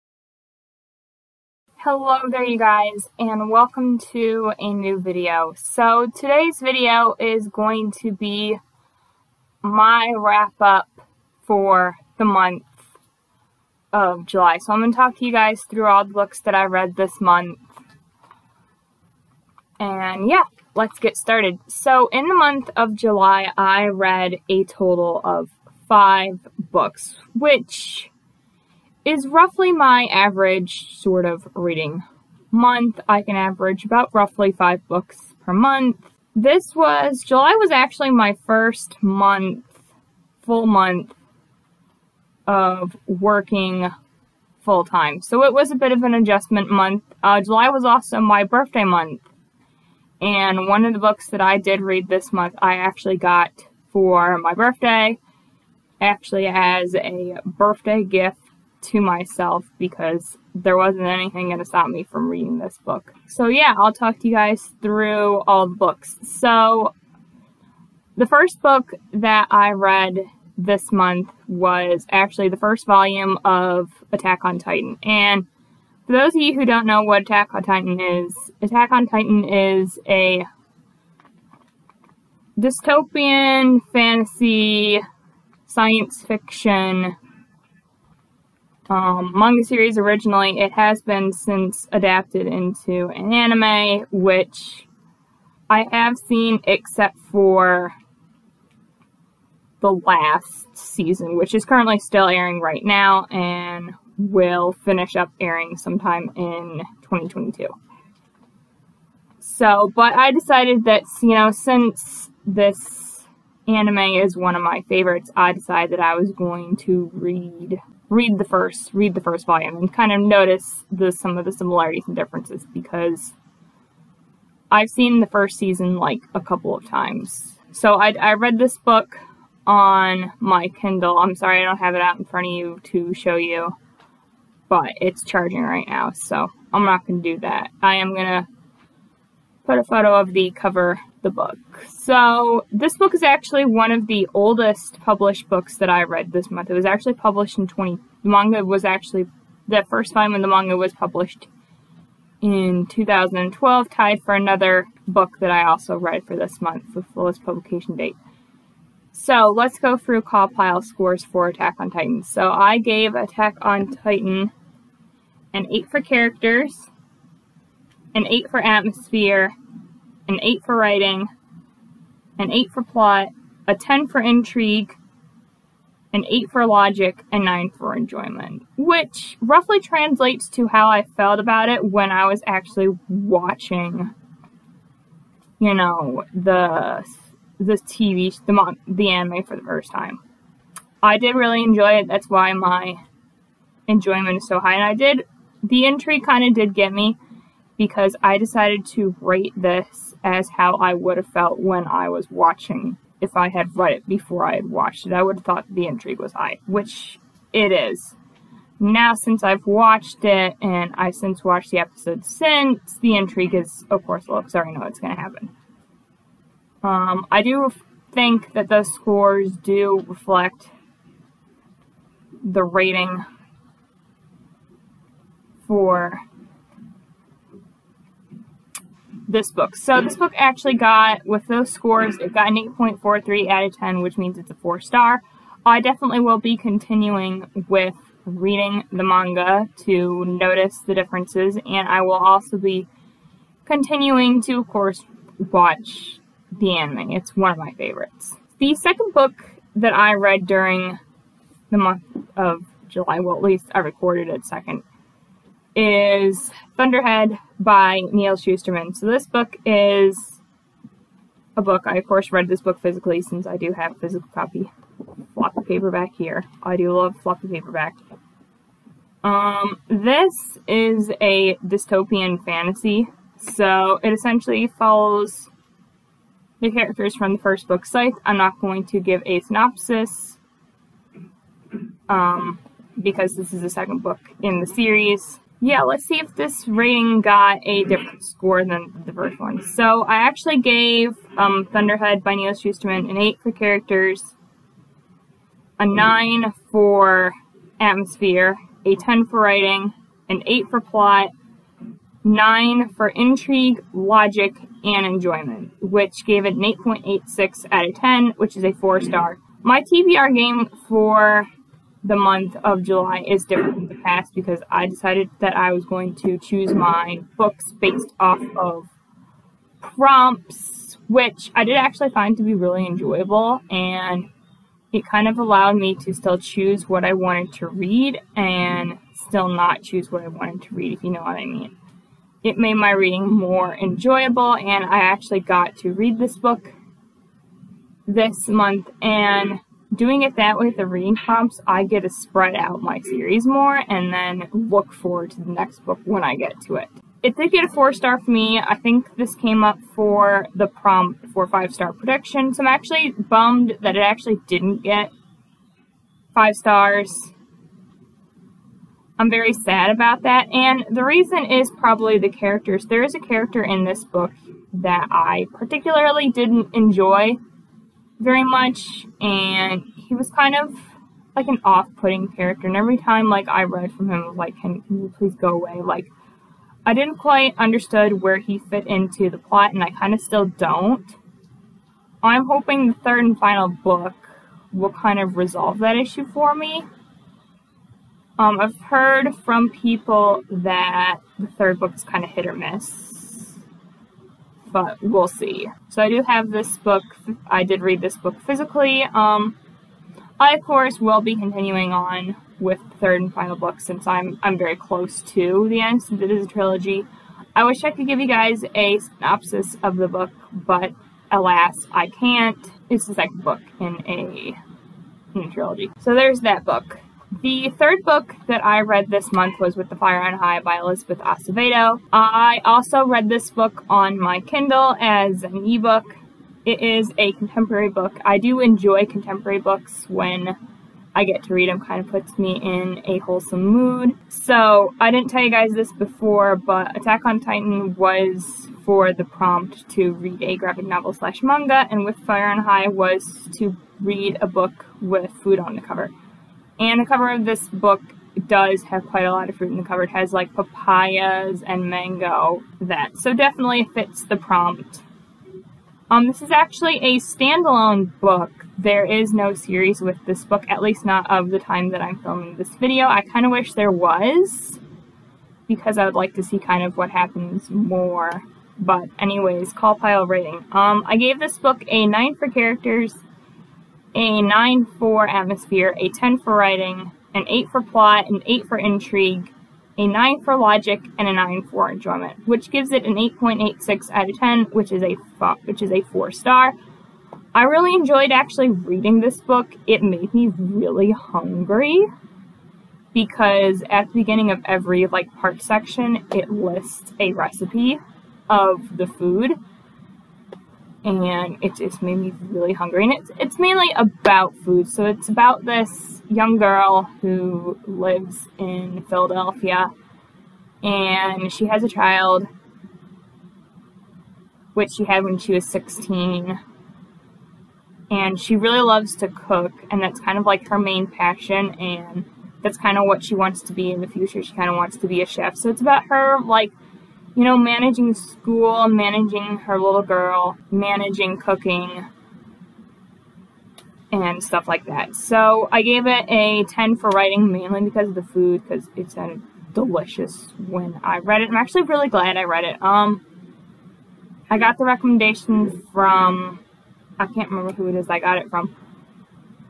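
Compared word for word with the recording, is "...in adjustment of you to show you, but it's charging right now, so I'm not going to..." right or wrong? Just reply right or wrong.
wrong.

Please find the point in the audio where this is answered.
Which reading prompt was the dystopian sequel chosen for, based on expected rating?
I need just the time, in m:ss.
5:51.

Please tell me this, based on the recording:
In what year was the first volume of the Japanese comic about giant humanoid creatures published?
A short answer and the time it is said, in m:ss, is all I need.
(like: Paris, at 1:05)
2012, at 2:32.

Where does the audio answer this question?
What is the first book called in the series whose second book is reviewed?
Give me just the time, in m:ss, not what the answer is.
4:37.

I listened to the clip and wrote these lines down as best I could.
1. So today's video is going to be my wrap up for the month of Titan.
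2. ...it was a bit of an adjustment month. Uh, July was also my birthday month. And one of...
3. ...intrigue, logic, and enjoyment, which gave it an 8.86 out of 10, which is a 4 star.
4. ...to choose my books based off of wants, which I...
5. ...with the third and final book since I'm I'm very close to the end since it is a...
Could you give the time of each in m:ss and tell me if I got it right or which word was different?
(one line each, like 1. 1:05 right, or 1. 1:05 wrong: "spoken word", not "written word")
1. 0:05 wrong: "July", not "Titan"
2. 0:45 right
3. 5:03 right
4. 5:16 wrong: "prompts", not "wants"
5. 6:42 right.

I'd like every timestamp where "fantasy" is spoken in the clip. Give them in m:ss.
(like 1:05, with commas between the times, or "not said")
1:23, 4:32.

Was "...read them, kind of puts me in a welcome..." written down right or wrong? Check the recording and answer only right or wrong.
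wrong.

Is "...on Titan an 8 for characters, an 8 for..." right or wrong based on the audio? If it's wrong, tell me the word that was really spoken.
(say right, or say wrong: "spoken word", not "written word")
right.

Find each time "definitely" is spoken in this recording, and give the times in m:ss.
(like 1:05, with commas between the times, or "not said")
3:55, 7:33.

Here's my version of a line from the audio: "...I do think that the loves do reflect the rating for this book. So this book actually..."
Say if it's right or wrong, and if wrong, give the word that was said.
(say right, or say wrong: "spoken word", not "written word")
wrong: "scores", not "loves".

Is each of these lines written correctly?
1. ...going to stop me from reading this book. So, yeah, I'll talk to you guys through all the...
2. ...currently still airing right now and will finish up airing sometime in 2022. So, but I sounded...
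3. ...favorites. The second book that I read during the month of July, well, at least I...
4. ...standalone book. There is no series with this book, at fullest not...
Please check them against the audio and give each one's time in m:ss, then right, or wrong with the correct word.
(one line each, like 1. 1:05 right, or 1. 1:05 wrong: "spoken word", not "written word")
1. 1:01 right
2. 1:41 wrong: "decided", not "sounded"
3. 4:07 right
4. 7:37 wrong: "least", not "fullest".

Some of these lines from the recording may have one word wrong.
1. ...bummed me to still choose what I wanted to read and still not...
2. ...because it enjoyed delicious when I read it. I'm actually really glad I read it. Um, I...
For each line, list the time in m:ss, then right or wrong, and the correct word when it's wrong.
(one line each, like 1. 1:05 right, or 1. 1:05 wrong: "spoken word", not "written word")
1. 5:25 wrong: "allowed", not "bummed"
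2. 8:58 wrong: "sounded", not "enjoyed".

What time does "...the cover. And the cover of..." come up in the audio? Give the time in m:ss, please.
7:25.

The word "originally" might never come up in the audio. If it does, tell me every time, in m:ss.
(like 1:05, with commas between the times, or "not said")
1:29.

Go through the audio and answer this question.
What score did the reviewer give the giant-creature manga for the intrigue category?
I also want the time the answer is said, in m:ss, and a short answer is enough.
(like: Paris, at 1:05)
10, at 2:53.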